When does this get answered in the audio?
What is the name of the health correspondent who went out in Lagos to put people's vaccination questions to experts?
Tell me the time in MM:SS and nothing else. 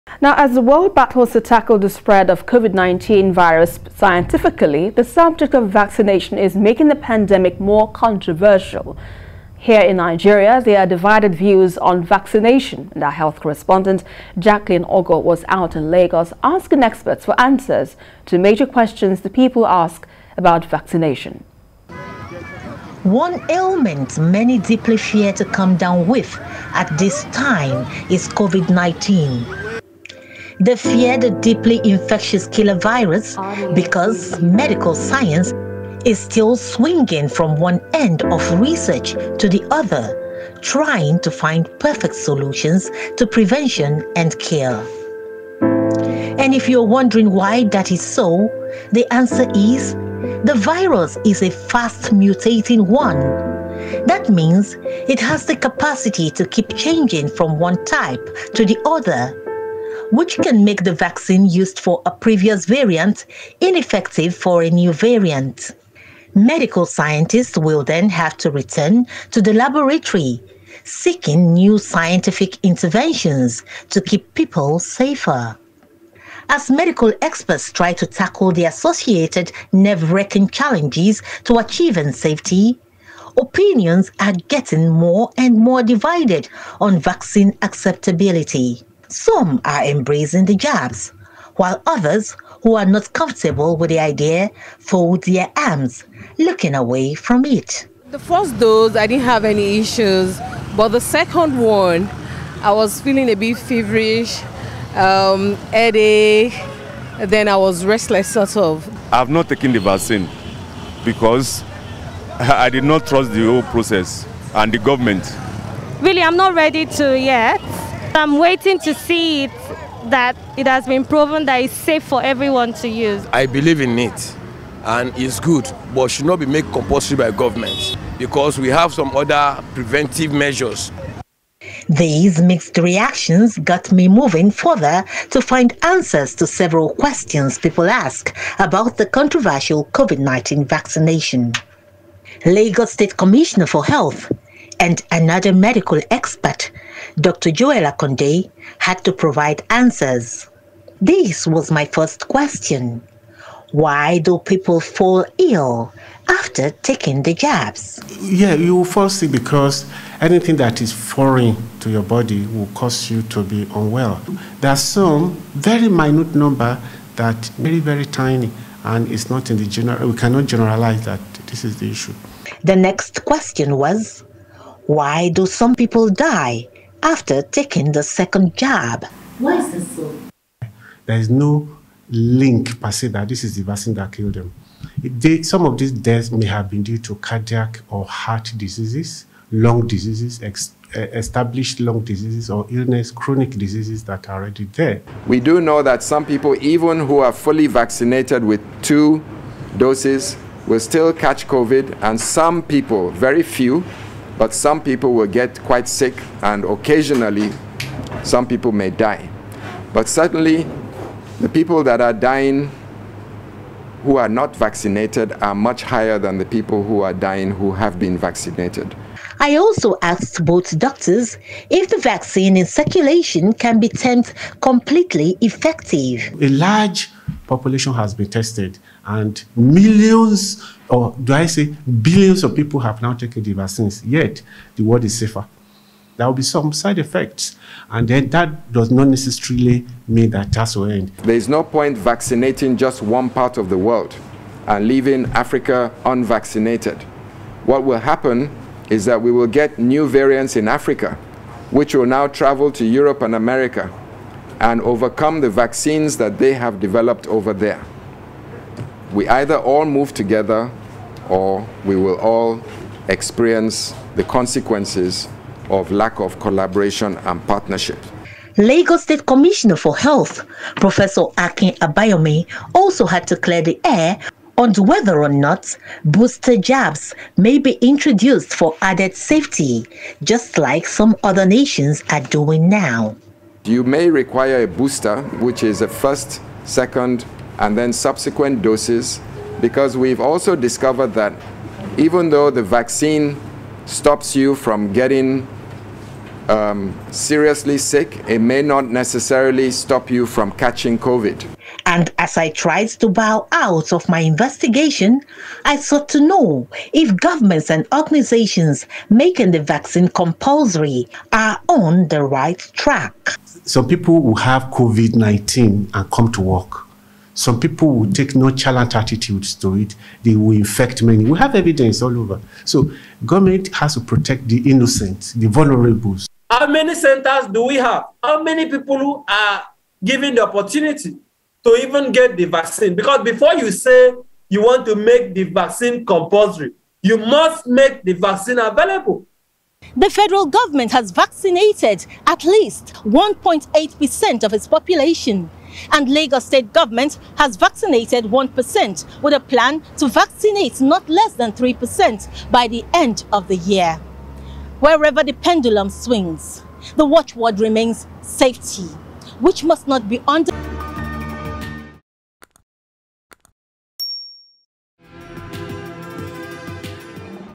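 00:14.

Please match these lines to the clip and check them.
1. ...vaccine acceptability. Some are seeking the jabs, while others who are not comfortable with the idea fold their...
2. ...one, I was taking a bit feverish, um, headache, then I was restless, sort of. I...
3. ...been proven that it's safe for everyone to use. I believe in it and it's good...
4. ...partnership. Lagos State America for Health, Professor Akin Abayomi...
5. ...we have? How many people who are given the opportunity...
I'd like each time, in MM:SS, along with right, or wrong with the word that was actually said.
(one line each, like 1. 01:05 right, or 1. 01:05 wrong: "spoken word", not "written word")
1. 01:26 wrong: "embracing", not "seeking"
2. 01:41 wrong: "feeling", not "taking"
3. 02:00 right
4. 04:27 wrong: "Commissioner", not "America"
5. 05:27 right.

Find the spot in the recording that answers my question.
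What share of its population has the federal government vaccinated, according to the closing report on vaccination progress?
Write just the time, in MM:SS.
05:43.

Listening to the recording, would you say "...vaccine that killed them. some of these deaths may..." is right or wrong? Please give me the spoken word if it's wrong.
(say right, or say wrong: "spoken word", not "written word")
right.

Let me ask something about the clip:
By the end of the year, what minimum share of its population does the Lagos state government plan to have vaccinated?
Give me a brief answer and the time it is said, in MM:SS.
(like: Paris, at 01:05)
3%, at 05:50.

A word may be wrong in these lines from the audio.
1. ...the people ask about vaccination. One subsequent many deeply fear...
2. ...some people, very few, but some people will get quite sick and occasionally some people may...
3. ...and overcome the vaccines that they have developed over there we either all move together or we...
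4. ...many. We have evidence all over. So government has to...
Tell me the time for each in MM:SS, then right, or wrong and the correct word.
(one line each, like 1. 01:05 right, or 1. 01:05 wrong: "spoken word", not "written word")
1. 00:19 wrong: "ailment", not "subsequent"
2. 03:22 right
3. 04:14 right
4. 05:21 right.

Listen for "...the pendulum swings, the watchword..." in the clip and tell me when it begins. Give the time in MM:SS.
05:55.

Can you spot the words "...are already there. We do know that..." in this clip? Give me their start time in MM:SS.
03:14.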